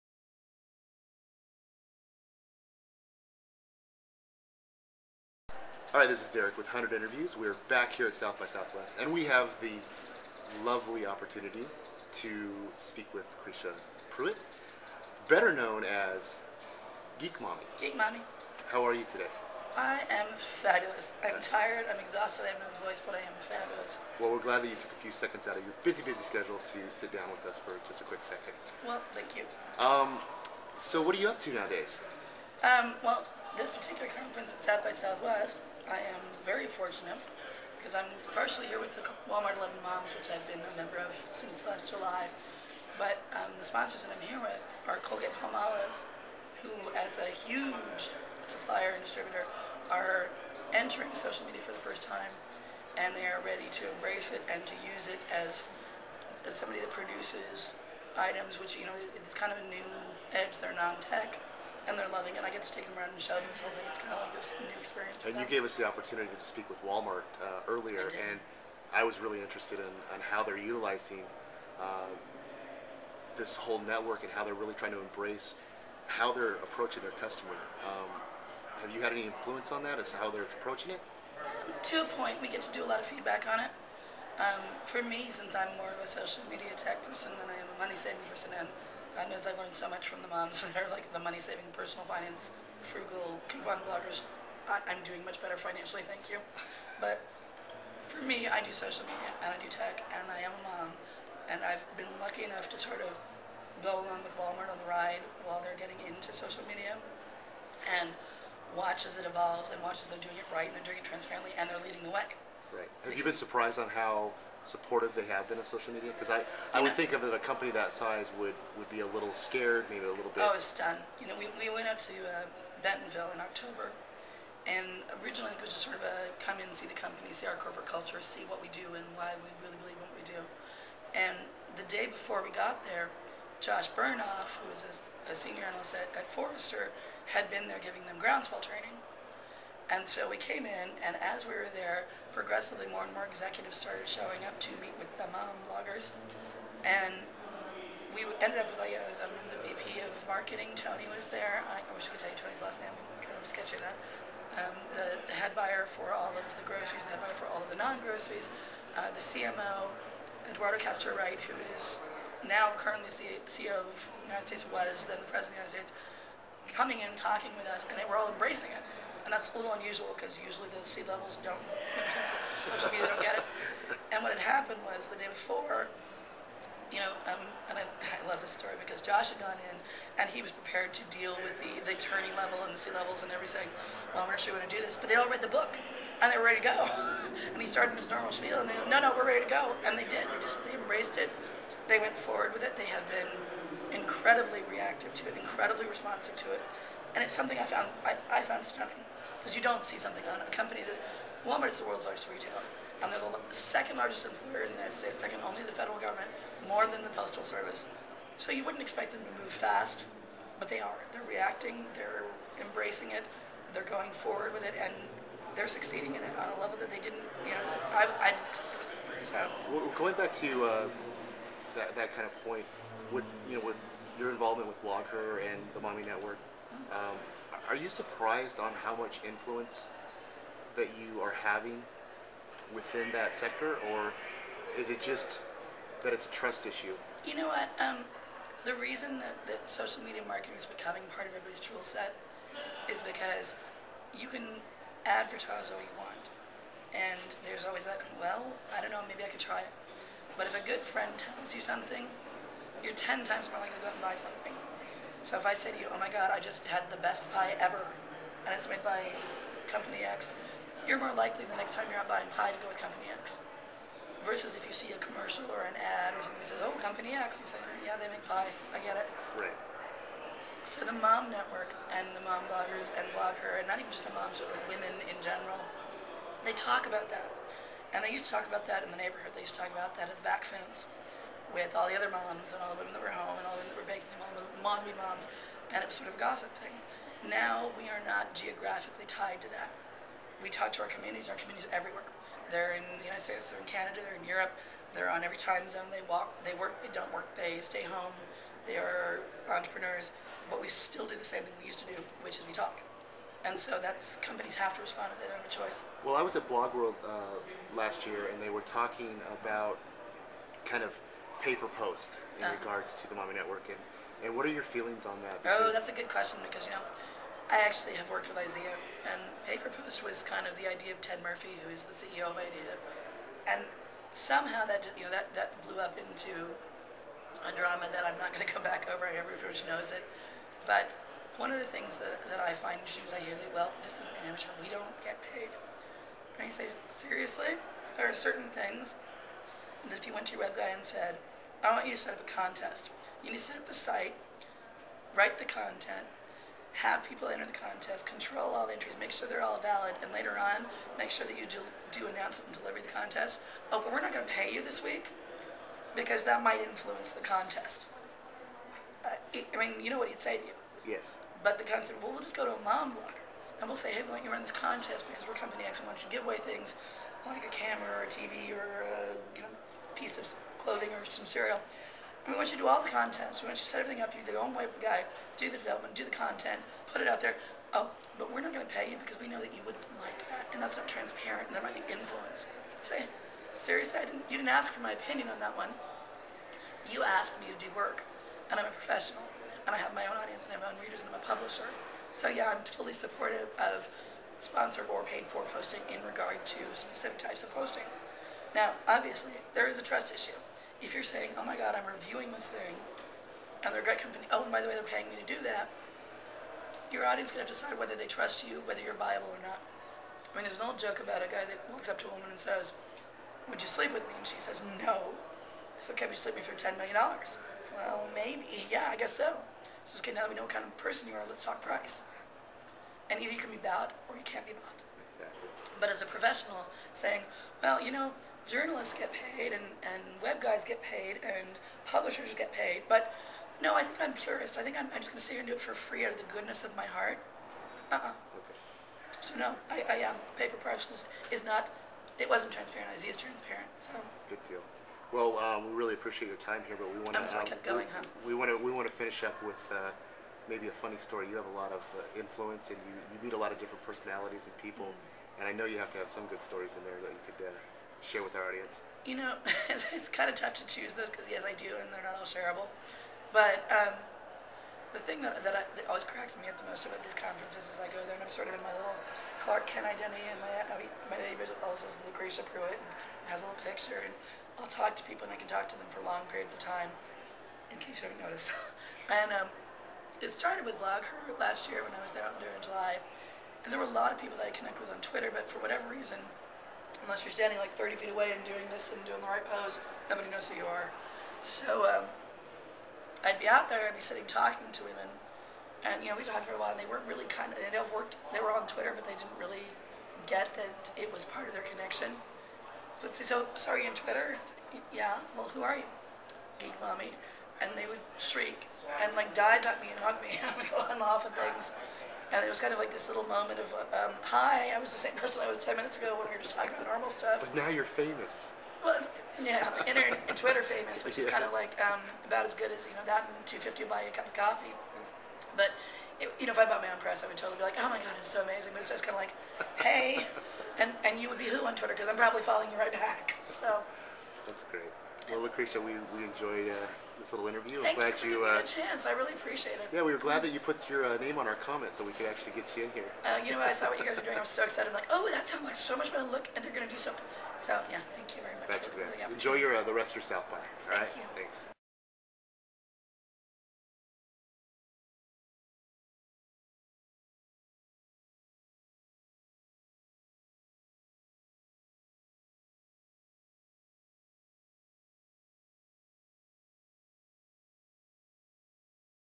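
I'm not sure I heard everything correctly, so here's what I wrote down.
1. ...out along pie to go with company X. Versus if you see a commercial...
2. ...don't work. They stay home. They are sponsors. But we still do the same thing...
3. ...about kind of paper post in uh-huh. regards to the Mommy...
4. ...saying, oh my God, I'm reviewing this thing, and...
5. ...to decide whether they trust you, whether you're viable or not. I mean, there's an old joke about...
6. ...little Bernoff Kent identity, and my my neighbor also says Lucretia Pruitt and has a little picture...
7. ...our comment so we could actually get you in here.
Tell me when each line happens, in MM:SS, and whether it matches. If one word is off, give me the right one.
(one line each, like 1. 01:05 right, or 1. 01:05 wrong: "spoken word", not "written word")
1. 04:22 wrong: "buying", not "along"
2. 04:56 wrong: "entrepreneurs", not "sponsors"
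3. 05:09 right
4. 06:41 right
5. 06:47 right
6. 07:48 wrong: "Clark", not "Bernoff"
7. 09:01 right.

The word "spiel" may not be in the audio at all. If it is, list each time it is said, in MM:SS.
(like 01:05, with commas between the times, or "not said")
03:08.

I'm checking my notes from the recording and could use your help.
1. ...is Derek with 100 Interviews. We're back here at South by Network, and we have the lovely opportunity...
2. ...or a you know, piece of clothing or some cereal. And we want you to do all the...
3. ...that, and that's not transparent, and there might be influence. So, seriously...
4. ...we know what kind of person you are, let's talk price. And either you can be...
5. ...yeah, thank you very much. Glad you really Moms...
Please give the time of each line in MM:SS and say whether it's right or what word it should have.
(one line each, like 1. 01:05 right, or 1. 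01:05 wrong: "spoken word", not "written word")
1. 00:06 wrong: "Southwest", not "Network"
2. 06:08 right
3. 06:20 right
4. 07:00 right
5. 09:07 wrong: "Enjoy", not "Moms".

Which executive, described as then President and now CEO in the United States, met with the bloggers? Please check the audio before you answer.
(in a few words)
Eduardo Castro Wright.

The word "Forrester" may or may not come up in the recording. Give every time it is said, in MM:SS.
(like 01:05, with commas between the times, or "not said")
02:16.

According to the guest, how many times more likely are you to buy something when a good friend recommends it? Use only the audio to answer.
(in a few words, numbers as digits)
10 times.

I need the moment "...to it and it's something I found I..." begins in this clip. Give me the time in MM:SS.
03:16.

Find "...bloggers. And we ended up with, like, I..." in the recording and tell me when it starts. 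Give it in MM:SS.
02:25.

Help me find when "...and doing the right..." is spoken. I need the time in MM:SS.
08:08.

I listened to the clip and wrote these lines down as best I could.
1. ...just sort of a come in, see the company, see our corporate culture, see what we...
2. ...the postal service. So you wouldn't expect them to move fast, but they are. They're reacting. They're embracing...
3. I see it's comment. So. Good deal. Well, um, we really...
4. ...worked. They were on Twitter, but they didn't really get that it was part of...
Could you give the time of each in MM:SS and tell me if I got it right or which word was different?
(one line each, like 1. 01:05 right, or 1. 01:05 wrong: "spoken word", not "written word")
1. 02:05 right
2. 03:27 right
3. 07:22 wrong: "transparent", not "comment"
4. 08:17 right.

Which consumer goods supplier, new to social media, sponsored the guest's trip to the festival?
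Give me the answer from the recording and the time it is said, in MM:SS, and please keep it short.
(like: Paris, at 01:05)
Colgate Palmolive, at 00:45.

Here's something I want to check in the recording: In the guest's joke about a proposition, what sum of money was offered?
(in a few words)
$10 million.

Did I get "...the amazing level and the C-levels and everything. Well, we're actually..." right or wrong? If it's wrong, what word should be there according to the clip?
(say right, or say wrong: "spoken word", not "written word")
wrong: "turning", not "amazing".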